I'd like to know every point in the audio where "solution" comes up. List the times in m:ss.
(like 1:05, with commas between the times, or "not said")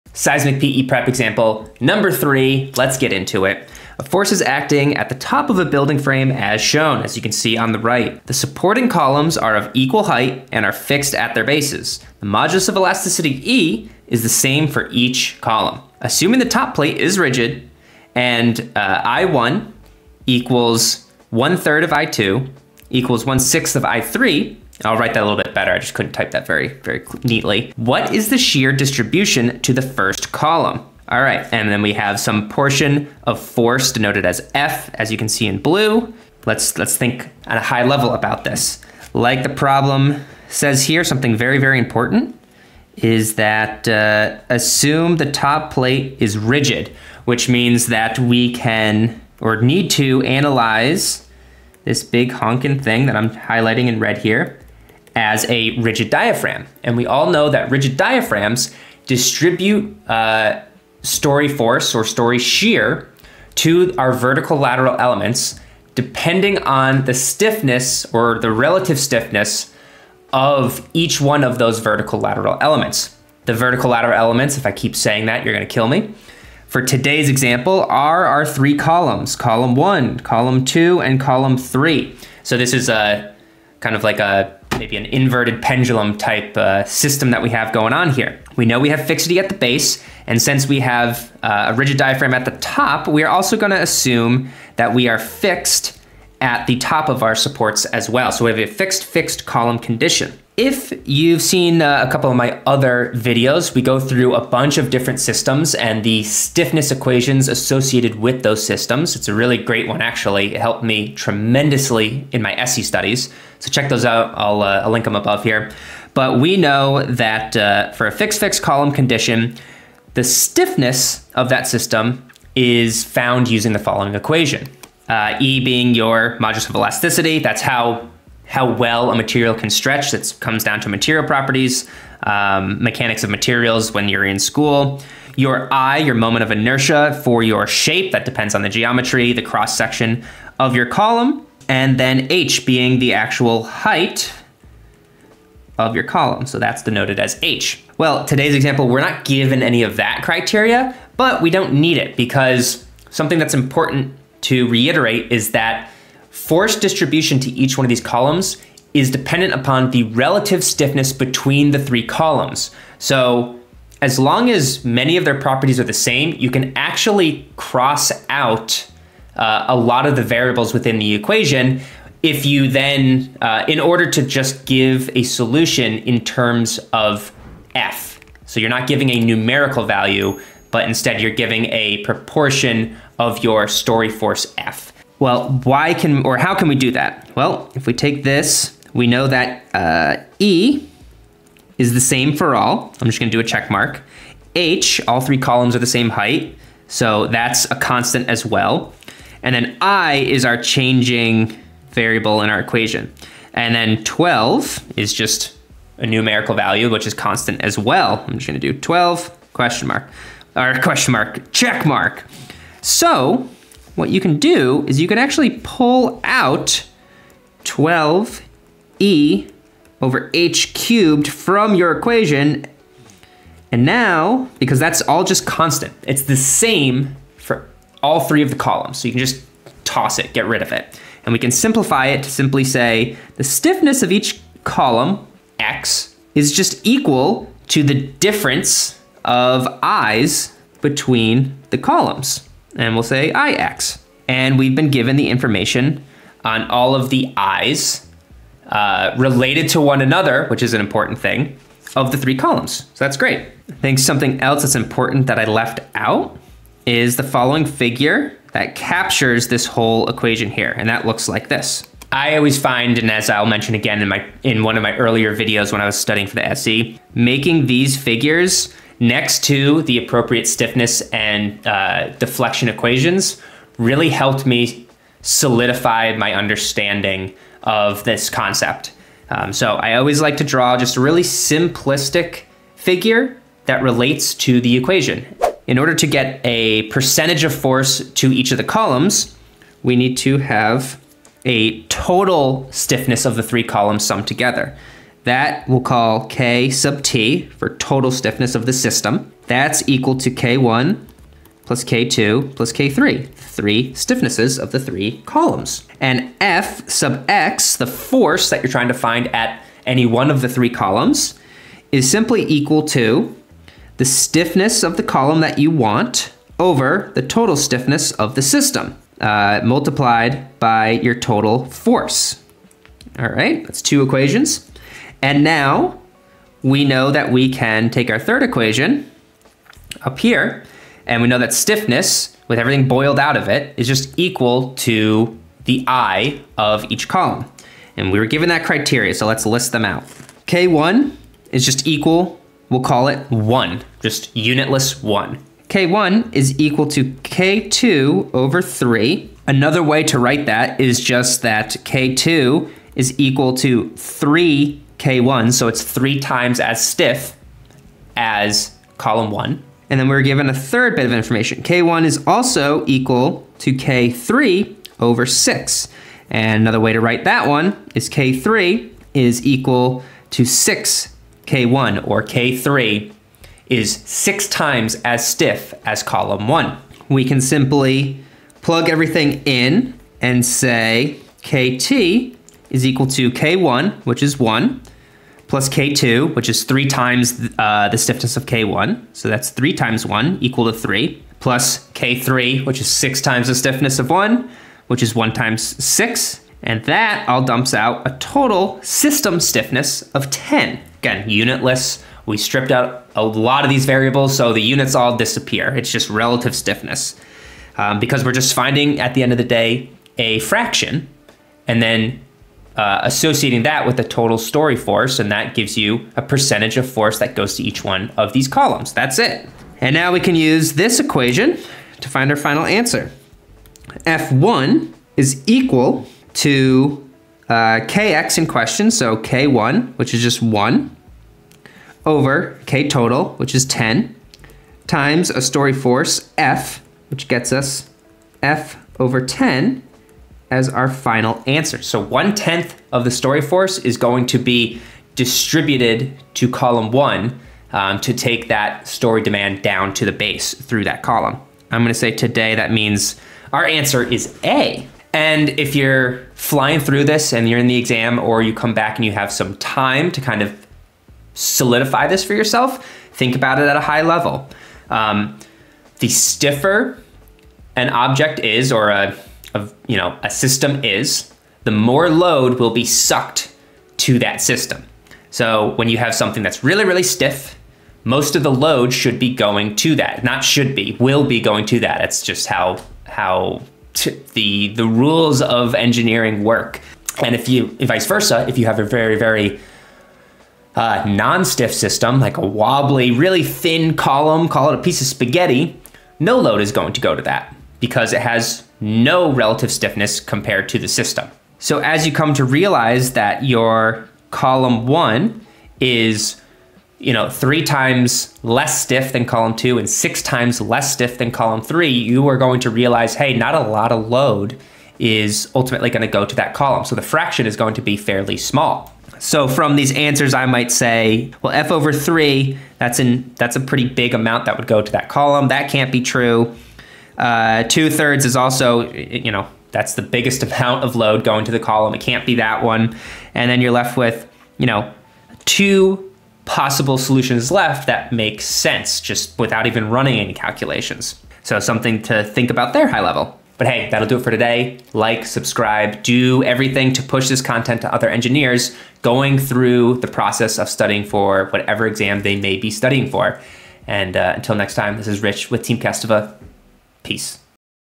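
2:55, 8:56.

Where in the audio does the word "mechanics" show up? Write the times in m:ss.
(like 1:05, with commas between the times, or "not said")
2:12.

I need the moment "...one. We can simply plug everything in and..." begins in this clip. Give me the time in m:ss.
6:16.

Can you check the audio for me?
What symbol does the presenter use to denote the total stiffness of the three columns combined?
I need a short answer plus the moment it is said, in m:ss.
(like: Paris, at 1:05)
K sub T, at 4:56.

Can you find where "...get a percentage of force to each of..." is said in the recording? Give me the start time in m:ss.
4:46.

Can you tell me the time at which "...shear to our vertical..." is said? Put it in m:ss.
1:02.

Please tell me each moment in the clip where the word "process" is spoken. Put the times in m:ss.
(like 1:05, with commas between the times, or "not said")
9:10.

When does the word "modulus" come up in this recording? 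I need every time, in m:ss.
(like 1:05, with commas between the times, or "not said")
0:12, 2:06.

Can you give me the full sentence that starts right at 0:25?
I just couldn't type that very, very neatly.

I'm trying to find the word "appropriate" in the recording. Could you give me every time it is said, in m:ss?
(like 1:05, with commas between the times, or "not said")
4:29.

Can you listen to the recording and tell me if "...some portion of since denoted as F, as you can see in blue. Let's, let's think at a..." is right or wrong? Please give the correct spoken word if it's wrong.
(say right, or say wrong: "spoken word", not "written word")
wrong: "force", not "since".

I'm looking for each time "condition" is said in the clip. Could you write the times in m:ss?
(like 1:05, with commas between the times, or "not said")
1:39, 1:58.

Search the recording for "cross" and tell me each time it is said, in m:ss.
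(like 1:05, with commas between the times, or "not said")
2:19, 2:47.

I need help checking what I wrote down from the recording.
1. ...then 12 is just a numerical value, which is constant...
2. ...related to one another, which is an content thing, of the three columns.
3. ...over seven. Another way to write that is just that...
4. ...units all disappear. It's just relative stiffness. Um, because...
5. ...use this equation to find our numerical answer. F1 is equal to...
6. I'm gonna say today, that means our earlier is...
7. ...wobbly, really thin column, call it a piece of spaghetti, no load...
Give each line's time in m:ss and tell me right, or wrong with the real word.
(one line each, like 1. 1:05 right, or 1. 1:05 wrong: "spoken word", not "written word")
1. 3:23 right
2. 4:09 wrong: "important", not "content"
3. 5:48 wrong: "three", not "seven"
4. 6:44 right
5. 7:00 wrong: "final", not "numerical"
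6. 7:31 wrong: "answer", not "earlier"
7. 8:12 right.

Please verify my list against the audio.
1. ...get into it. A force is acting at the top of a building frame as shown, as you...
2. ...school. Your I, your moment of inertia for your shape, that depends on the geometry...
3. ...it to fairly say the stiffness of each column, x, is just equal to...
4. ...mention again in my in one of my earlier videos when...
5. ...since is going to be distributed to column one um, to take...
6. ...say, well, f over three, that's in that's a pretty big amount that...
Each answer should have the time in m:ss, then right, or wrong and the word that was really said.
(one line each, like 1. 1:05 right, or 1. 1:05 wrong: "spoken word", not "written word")
1. 0:02 right
2. 2:14 right
3. 3:52 wrong: "simply", not "fairly"
4. 4:23 right
5. 7:23 wrong: "force", not "since"
6. 8:40 right.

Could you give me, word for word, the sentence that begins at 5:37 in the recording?
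And we were given that criteria, so let's list them out.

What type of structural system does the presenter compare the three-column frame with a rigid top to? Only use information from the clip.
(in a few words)
inverted pendulum.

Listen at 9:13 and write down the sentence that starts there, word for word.
And uh, until next time, this is Rich with Team Kestävä.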